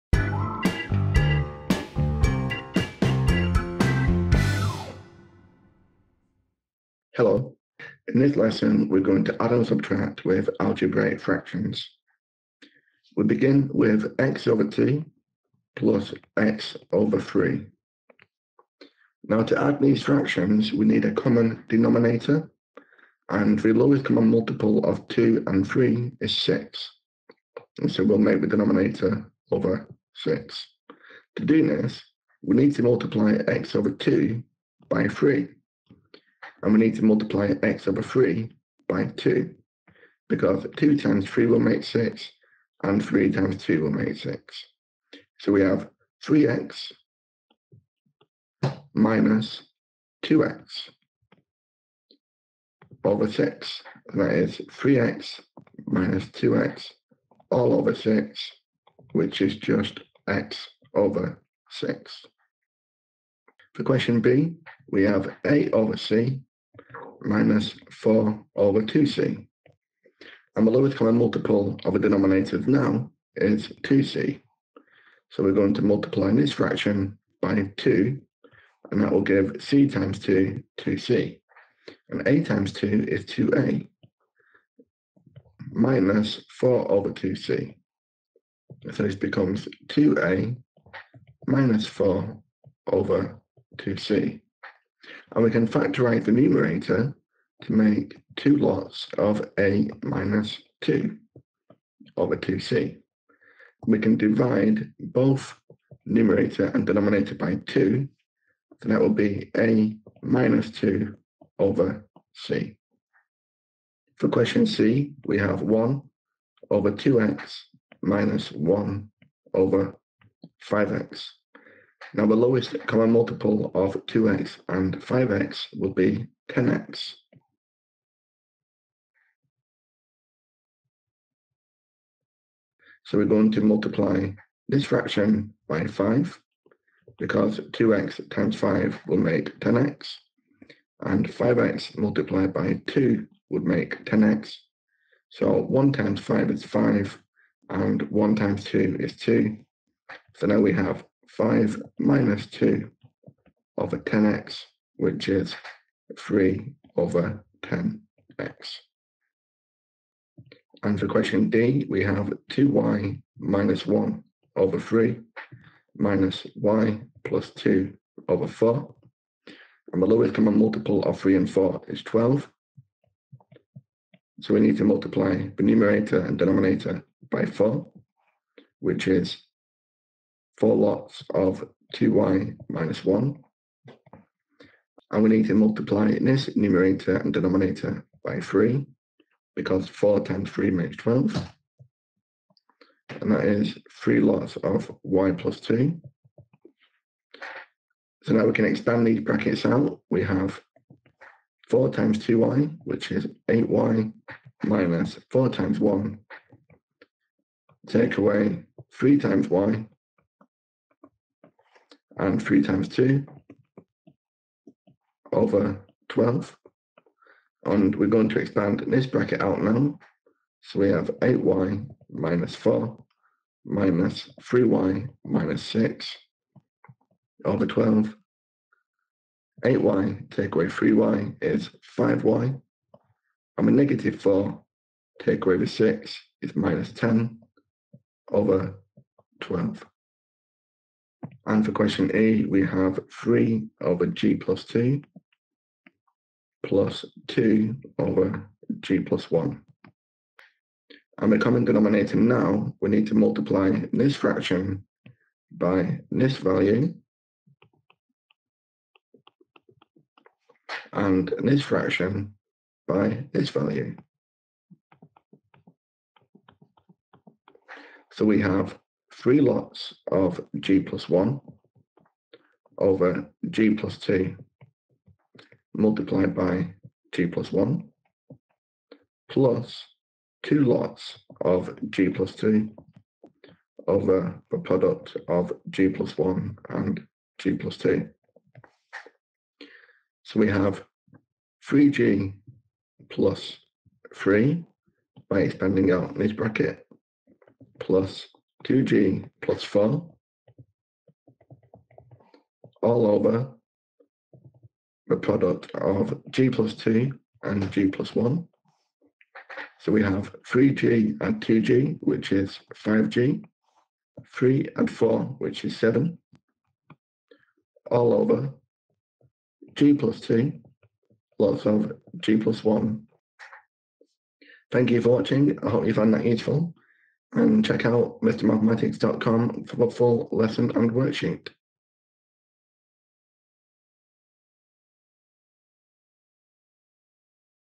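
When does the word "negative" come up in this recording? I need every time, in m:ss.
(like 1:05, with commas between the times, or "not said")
3:53.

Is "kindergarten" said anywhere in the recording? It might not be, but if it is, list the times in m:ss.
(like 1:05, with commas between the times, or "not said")
not said.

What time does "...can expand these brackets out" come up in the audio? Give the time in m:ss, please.
3:18.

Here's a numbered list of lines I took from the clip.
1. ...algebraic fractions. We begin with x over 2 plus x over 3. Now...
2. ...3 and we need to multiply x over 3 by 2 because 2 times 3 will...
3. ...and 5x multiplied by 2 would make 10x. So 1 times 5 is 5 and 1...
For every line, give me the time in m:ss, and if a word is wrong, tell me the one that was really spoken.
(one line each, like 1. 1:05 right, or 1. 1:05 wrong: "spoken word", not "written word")
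1. 0:10 right
2. 0:35 right
3. 2:21 right.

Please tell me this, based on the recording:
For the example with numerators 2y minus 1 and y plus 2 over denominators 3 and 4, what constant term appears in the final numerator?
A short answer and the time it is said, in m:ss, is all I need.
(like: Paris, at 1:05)
-10, at 3:56.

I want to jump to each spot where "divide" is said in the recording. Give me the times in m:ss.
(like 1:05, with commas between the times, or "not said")
1:44.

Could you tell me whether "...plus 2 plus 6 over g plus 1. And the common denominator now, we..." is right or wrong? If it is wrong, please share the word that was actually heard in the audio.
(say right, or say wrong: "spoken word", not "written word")
wrong: "2", not "6".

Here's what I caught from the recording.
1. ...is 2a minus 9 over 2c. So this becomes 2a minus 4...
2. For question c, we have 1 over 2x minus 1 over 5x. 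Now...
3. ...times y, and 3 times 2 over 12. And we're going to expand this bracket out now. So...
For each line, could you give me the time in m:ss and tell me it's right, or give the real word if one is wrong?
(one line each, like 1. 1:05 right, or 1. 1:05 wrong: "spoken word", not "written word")
1. 1:23 wrong: "4", not "9"
2. 1:54 right
3. 3:29 right.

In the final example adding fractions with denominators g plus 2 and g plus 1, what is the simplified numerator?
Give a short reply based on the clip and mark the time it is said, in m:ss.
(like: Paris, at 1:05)
5g + 7, at 5:12.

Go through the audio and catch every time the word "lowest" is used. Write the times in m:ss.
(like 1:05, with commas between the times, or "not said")
0:23, 1:10, 2:02, 2:50.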